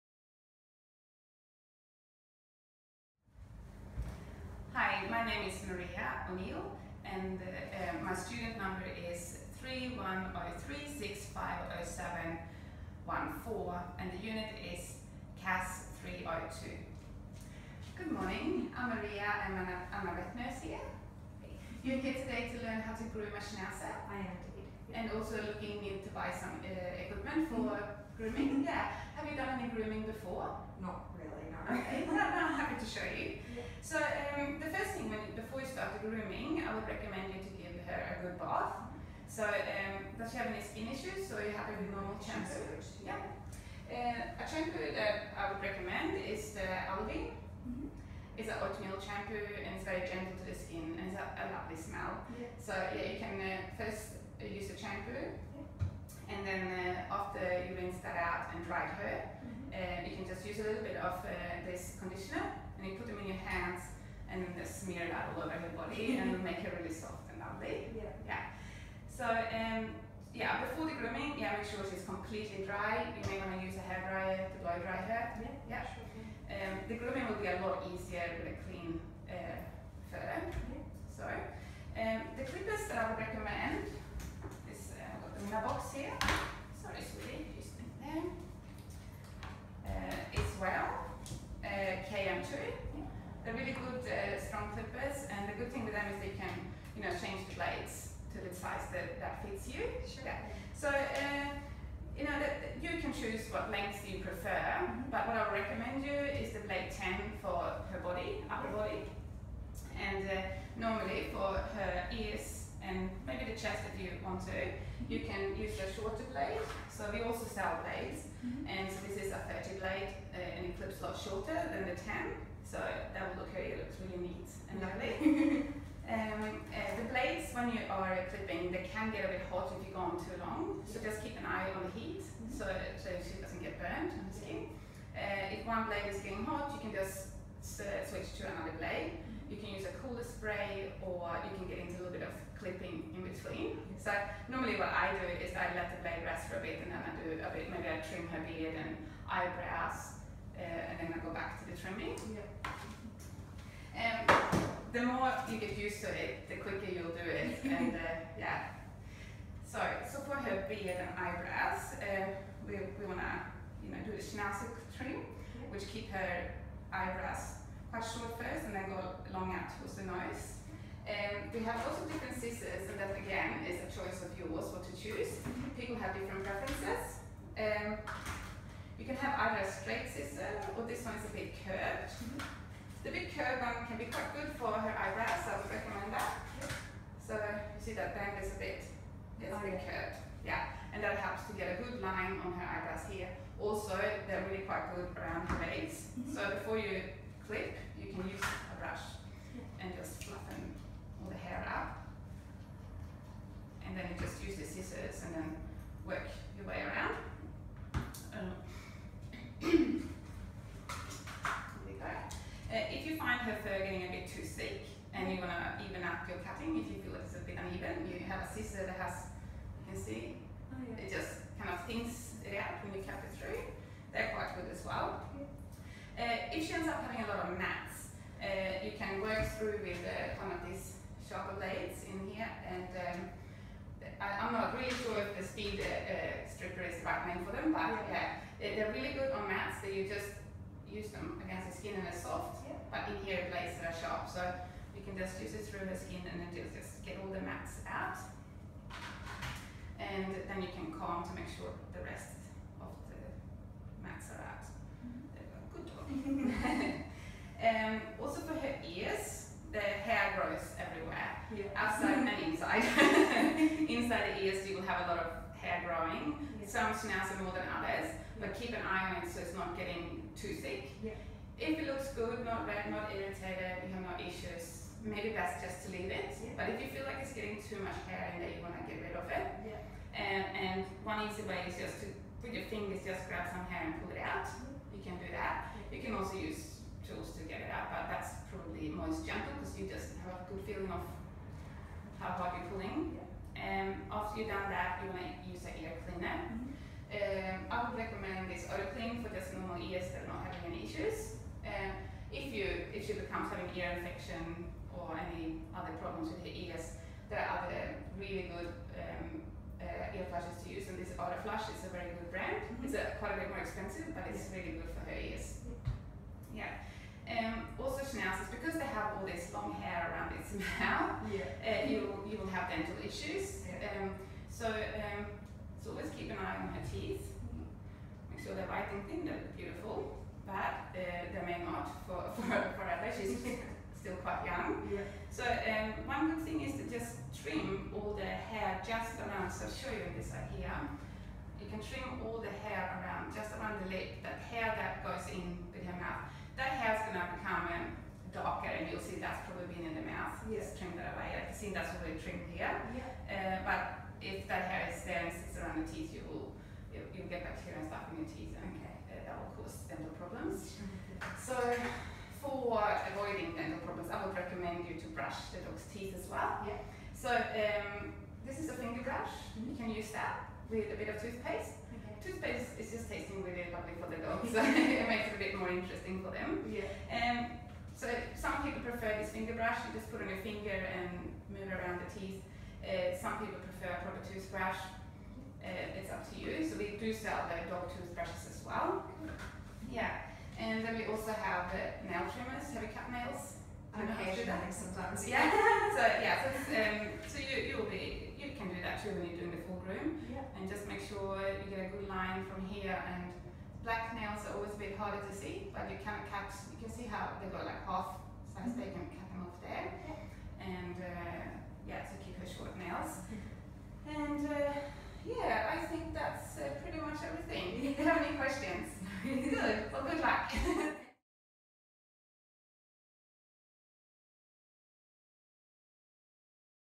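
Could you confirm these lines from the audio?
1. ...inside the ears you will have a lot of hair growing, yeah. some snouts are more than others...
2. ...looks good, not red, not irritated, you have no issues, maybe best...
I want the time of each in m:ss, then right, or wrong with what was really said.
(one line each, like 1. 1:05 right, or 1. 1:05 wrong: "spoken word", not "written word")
1. 4:23 right
2. 4:31 right.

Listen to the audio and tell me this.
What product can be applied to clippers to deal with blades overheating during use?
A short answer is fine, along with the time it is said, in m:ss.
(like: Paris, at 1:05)
Cooler spray, at 2:20.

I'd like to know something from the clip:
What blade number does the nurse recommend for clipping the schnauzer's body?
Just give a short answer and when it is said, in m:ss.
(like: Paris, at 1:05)
10, at 1:46.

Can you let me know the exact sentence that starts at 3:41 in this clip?
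it just kind of thins it out when you cut it through.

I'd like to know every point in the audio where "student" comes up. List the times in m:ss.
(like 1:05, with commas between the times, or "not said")
0:08.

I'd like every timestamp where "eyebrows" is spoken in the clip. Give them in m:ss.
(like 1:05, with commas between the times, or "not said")
2:29, 2:41, 2:46, 3:04, 3:12.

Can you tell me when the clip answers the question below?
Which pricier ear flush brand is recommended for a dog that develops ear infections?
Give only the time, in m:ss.
5:11.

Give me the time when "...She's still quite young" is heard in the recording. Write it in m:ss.
5:33.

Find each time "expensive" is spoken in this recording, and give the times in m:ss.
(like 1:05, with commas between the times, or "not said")
5:13.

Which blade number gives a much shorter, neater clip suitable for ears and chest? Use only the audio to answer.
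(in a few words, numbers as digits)
30.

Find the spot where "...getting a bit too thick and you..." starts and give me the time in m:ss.
3:33.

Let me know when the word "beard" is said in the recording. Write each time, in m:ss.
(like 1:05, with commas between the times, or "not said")
2:28, 2:40.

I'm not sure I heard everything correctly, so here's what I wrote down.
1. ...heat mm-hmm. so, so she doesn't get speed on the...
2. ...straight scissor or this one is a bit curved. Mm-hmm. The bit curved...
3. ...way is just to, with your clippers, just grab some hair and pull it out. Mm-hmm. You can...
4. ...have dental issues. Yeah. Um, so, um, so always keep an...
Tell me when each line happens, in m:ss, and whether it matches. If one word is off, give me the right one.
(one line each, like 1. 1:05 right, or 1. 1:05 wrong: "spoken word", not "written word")
1. 2:11 wrong: "burned", not "speed"
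2. 2:59 right
3. 4:41 wrong: "fingers", not "clippers"
4. 5:22 right.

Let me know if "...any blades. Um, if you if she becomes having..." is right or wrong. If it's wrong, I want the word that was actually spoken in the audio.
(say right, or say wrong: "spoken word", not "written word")
wrong: "issues", not "blades".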